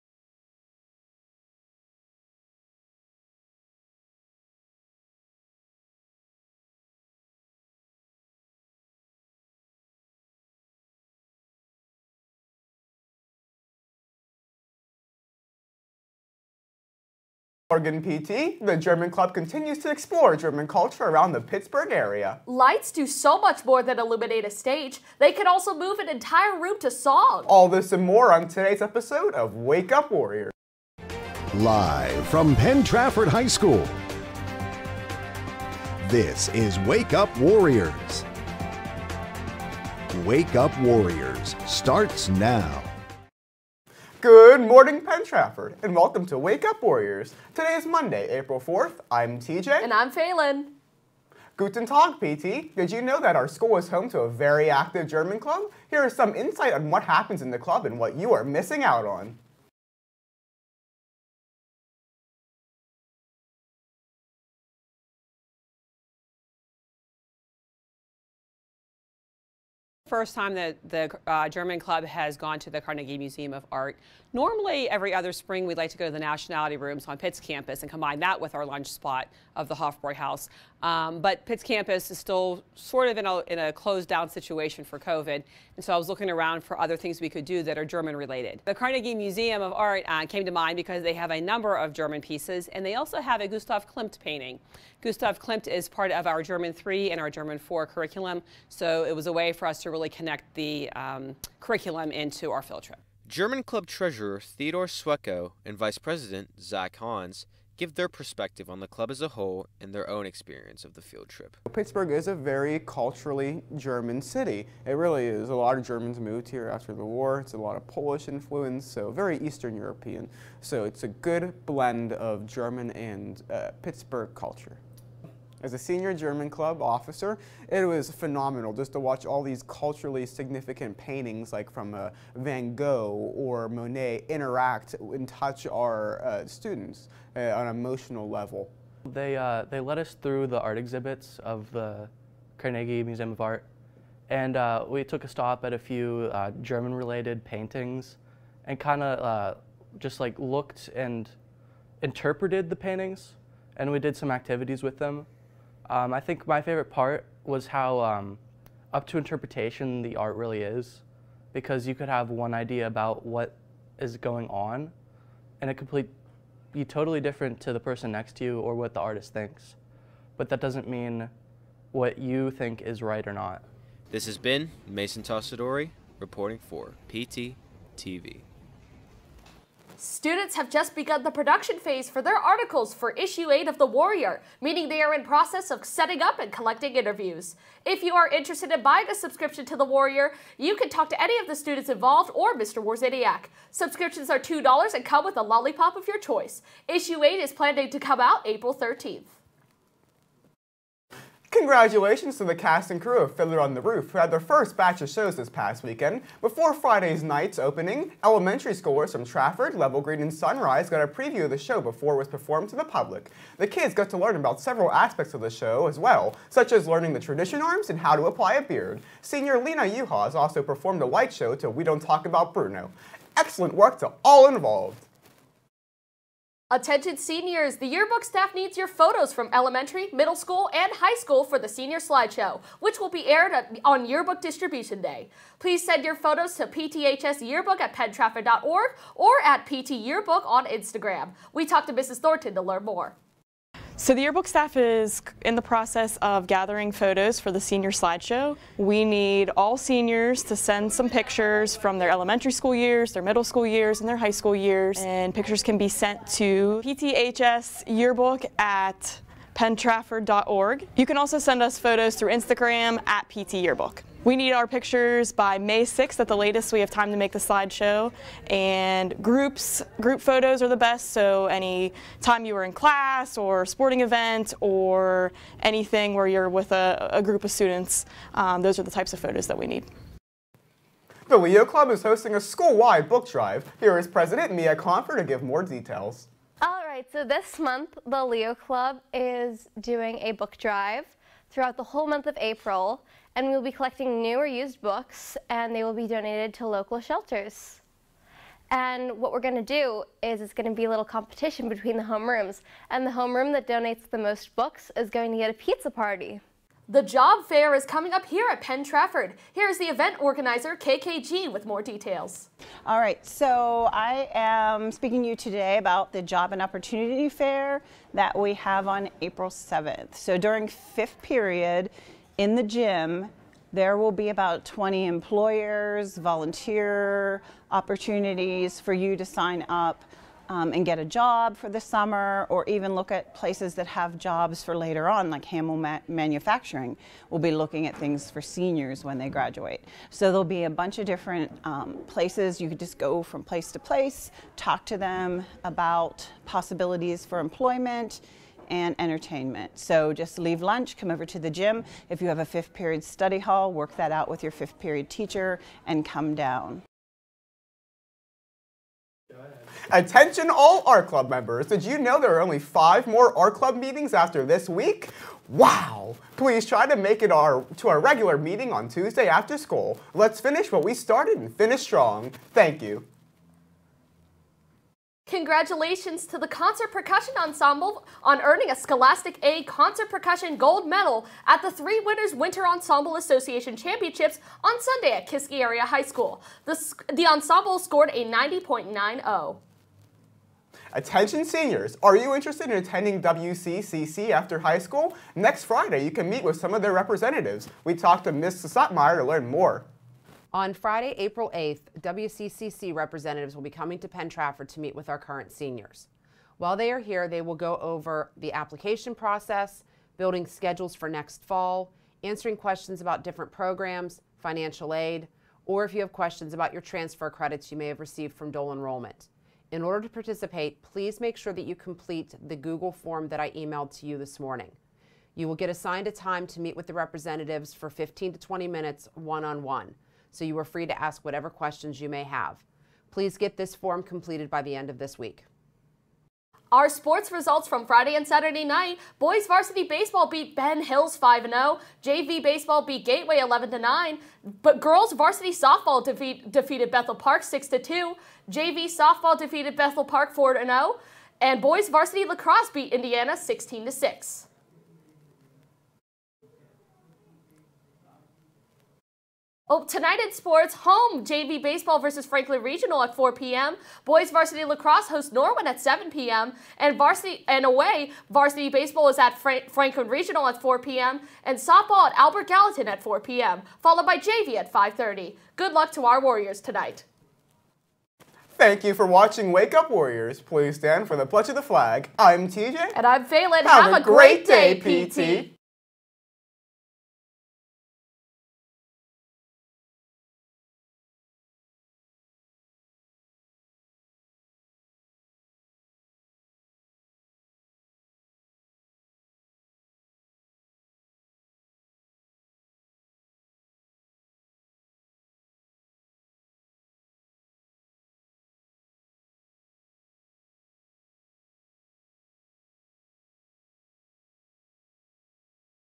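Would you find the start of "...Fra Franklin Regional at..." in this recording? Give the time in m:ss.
7:49.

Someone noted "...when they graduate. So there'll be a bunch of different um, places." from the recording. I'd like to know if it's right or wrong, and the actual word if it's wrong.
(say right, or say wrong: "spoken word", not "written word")
right.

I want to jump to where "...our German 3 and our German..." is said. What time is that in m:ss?
1:36.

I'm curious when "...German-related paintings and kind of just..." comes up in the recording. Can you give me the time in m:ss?
2:26.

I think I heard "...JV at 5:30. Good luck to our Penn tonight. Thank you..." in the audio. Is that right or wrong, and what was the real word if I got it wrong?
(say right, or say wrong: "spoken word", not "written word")
wrong: "Warriors", not "Penn".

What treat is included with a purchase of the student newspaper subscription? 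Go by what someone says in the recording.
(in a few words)
A lollipop.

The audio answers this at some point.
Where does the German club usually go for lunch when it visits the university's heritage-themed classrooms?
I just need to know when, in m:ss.
1:19.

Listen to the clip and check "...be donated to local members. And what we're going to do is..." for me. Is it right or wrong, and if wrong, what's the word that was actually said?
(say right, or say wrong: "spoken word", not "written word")
wrong: "shelters", not "members".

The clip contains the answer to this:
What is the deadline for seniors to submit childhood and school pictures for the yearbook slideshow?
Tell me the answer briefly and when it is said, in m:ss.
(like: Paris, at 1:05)
May 6th, at 4:25.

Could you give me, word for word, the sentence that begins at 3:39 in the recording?
Senior Lena Yuhas also performed a light show to We Don't Talk About Bruno.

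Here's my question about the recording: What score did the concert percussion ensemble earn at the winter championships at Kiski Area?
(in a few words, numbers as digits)
90.90.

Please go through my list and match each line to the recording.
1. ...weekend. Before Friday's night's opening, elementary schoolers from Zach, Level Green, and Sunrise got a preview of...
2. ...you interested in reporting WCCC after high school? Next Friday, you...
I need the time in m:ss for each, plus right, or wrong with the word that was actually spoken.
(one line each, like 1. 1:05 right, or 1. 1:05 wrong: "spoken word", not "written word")
1. 3:25 wrong: "Trafford", not "Zach"
2. 6:32 wrong: "attending", not "reporting".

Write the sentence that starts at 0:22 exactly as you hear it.
Lights do so much more than illuminate a stage.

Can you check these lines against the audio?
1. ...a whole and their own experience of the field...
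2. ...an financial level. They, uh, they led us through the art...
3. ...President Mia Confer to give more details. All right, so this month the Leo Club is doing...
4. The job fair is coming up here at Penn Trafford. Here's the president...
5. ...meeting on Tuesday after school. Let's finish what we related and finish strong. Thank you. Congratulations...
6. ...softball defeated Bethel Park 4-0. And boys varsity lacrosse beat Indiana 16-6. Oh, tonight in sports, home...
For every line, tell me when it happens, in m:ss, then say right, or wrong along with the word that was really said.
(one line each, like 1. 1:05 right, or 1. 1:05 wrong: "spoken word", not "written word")
1. 1:49 right
2. 2:17 wrong: "emotional", not "financial"
3. 4:44 right
4. 5:06 wrong: "event", not "president"
5. 6:08 wrong: "started", not "related"
6. 7:28 right.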